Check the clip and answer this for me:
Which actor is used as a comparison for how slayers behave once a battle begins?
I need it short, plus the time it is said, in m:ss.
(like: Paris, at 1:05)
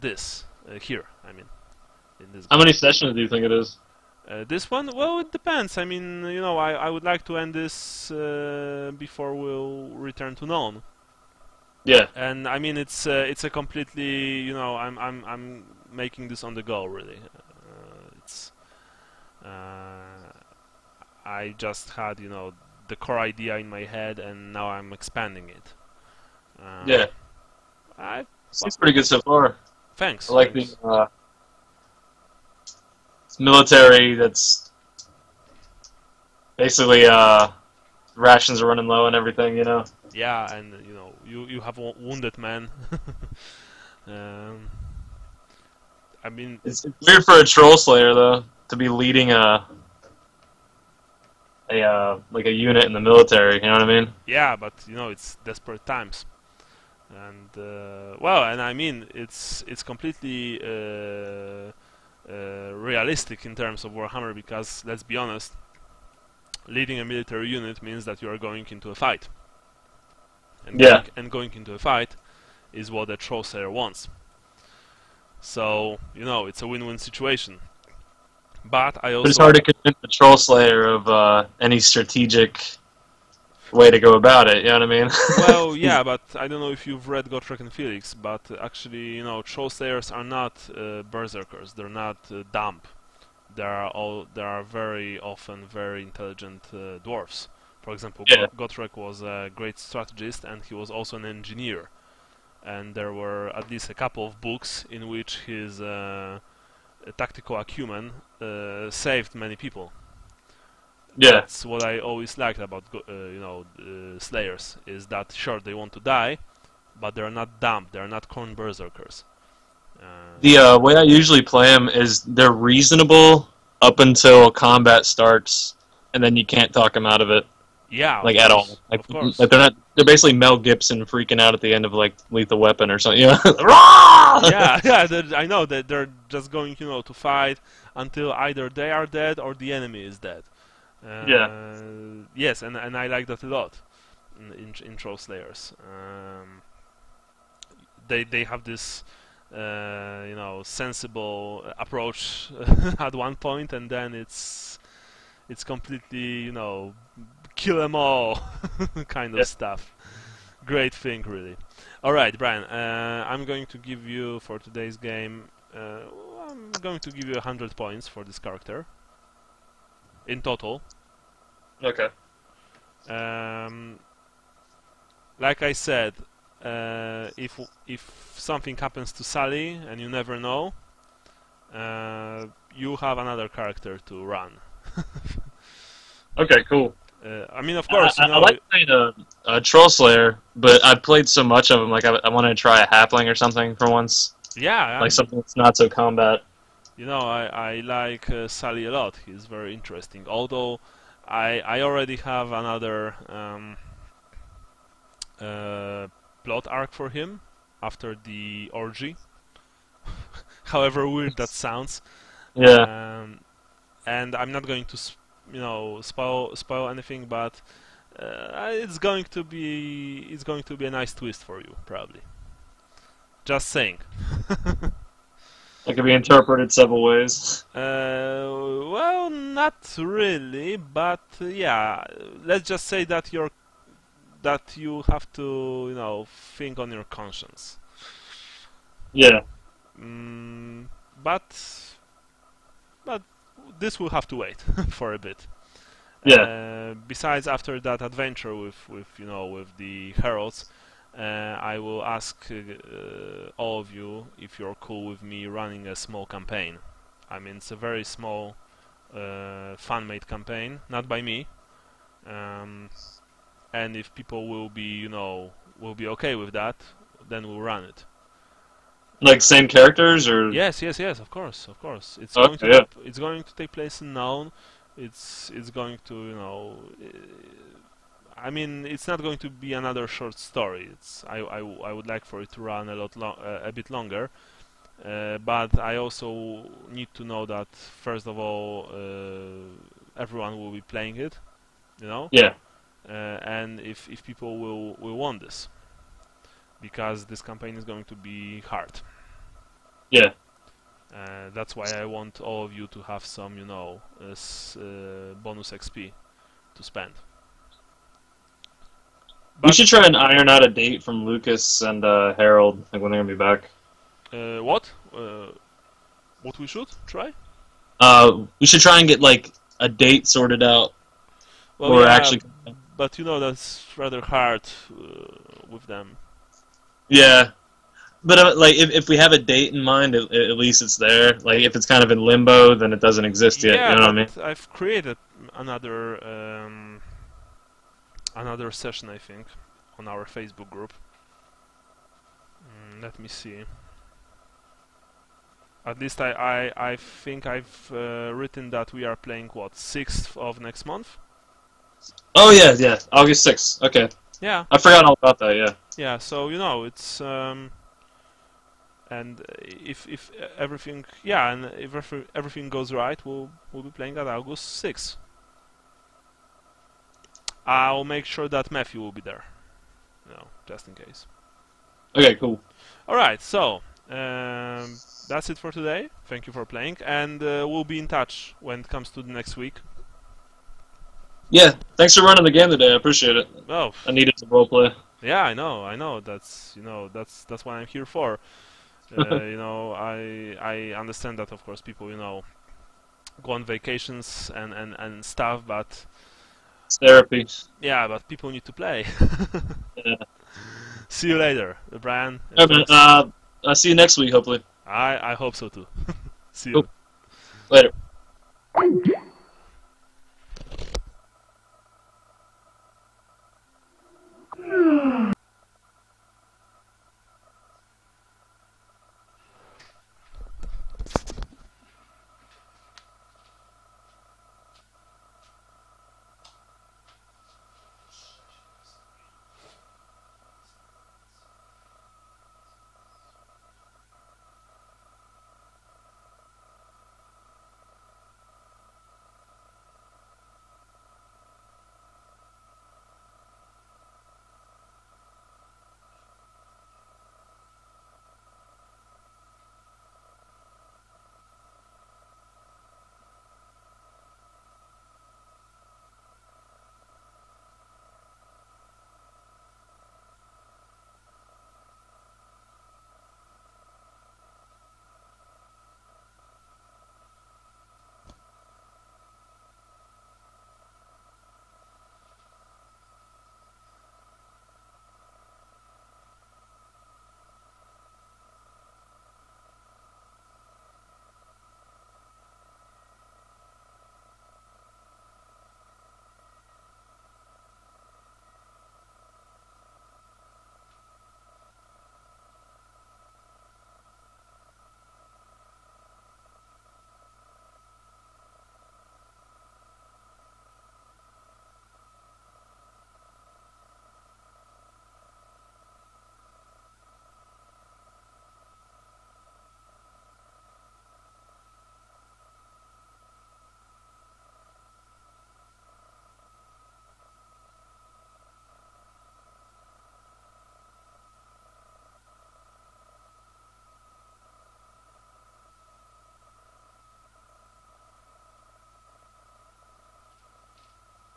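Mel Gibson, at 2:10.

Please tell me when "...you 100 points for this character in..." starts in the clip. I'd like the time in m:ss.
2:47.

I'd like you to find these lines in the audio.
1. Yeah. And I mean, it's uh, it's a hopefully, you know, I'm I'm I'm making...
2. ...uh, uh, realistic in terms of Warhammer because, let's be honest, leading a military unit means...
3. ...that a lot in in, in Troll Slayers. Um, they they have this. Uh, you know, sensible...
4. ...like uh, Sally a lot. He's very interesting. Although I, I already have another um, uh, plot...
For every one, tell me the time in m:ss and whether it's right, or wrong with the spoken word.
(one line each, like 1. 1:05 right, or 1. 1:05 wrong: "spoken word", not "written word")
1. 0:11 wrong: "completely", not "hopefully"
2. 1:00 right
3. 2:23 right
4. 3:17 right.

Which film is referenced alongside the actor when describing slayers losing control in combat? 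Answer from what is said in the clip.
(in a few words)
Lethal Weapon.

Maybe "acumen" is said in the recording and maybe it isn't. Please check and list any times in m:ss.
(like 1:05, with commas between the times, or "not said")
1:47.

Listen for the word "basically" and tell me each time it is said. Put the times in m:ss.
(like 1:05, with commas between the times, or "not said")
0:36, 2:10.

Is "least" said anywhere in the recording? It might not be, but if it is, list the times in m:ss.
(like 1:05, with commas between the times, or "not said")
1:43, 5:30, 5:45.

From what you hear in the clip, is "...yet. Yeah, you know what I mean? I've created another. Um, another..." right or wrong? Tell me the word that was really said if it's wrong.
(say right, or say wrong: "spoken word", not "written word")
right.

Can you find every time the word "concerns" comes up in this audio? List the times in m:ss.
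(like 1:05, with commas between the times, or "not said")
not said.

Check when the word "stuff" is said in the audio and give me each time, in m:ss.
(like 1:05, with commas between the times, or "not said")
2:39, 6:35.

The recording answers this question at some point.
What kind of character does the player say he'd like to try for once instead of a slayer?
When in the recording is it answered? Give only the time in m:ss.
3:12.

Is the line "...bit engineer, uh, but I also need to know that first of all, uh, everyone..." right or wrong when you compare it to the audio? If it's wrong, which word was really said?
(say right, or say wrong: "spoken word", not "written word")
wrong: "longer", not "engineer".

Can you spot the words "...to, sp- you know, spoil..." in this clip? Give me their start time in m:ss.
3:34.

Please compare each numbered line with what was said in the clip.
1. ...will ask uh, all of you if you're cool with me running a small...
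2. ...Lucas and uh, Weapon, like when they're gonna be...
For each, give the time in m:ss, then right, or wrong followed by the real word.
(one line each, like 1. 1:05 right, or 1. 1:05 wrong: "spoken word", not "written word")
1. 4:11 right
2. 5:11 wrong: "Harold", not "Weapon".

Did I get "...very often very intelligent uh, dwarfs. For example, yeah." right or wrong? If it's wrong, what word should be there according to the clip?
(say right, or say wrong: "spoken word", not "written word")
right.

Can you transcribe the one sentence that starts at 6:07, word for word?
I'll make sure that Matthew will be there.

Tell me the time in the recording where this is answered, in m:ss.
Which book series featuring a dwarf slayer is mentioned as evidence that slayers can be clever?
1:27.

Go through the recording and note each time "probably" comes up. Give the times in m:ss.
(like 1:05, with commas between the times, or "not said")
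3:41.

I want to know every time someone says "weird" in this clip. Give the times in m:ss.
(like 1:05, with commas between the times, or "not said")
0:47, 3:31.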